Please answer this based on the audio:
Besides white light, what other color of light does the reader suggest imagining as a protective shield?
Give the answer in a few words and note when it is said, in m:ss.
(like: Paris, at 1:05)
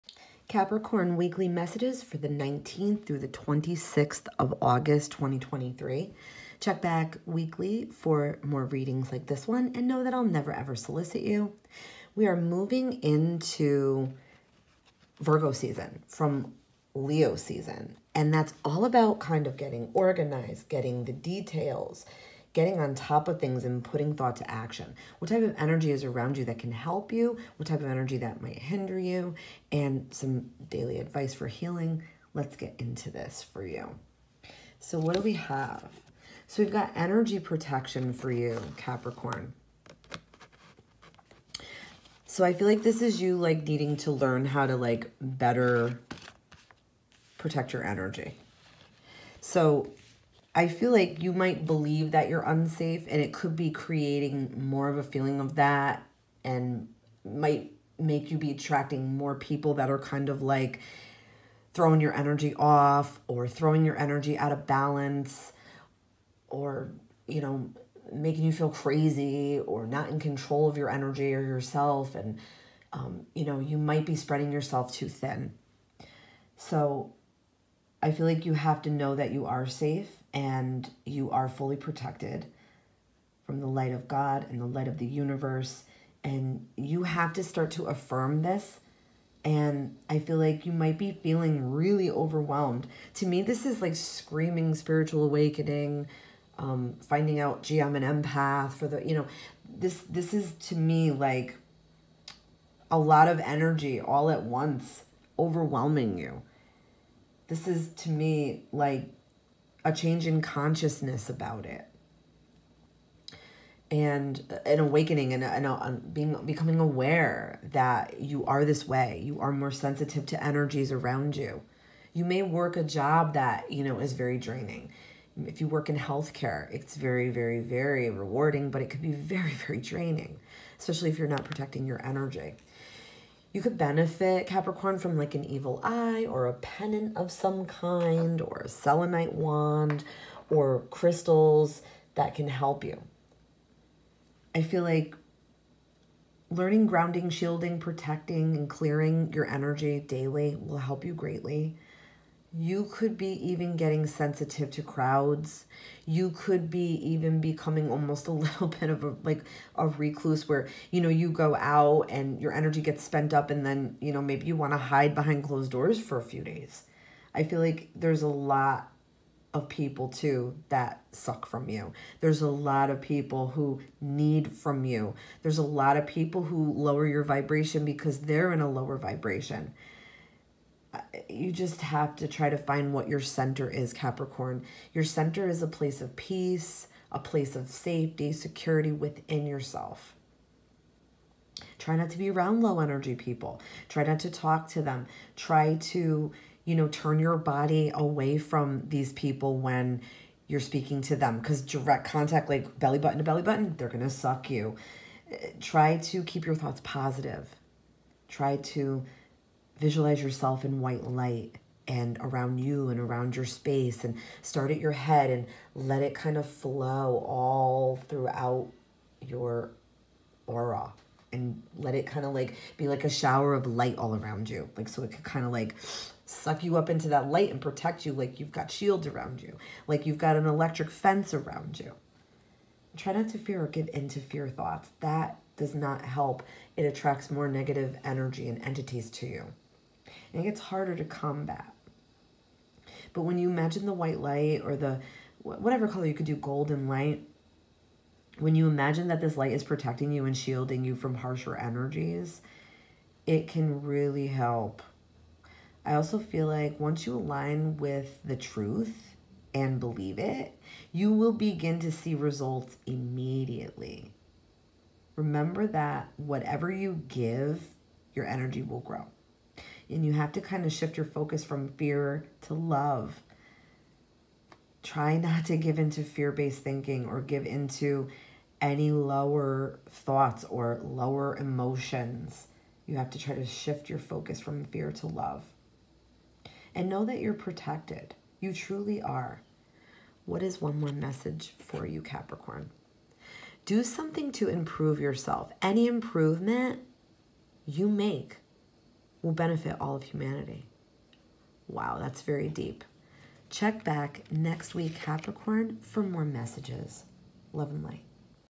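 Golden, at 4:06.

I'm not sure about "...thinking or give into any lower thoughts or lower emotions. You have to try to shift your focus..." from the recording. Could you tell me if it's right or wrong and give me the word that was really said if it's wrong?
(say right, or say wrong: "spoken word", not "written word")
right.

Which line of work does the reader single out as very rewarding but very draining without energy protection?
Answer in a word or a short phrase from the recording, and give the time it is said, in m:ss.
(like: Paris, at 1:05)
Healthcare, at 2:05.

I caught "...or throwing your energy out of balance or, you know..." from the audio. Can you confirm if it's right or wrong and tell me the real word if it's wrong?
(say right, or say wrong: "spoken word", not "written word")
right.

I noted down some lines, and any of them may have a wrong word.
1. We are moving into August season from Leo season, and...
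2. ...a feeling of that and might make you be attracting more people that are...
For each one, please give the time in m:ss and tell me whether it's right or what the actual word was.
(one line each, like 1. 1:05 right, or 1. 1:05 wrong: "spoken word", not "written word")
1. 0:12 wrong: "Virgo", not "August"
2. 0:54 right.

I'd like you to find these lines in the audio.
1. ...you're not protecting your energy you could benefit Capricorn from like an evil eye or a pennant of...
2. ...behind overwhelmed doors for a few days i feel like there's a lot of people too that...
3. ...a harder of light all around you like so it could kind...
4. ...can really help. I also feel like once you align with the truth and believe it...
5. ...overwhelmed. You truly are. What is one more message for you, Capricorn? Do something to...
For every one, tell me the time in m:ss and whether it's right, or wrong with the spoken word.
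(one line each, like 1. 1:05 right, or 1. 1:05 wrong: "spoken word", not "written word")
1. 2:11 right
2. 2:45 wrong: "closed", not "overwhelmed"
3. 3:43 wrong: "shower", not "harder"
4. 4:13 right
5. 4:47 wrong: "protected", not "overwhelmed".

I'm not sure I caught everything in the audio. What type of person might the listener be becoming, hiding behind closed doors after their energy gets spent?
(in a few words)
A recluse.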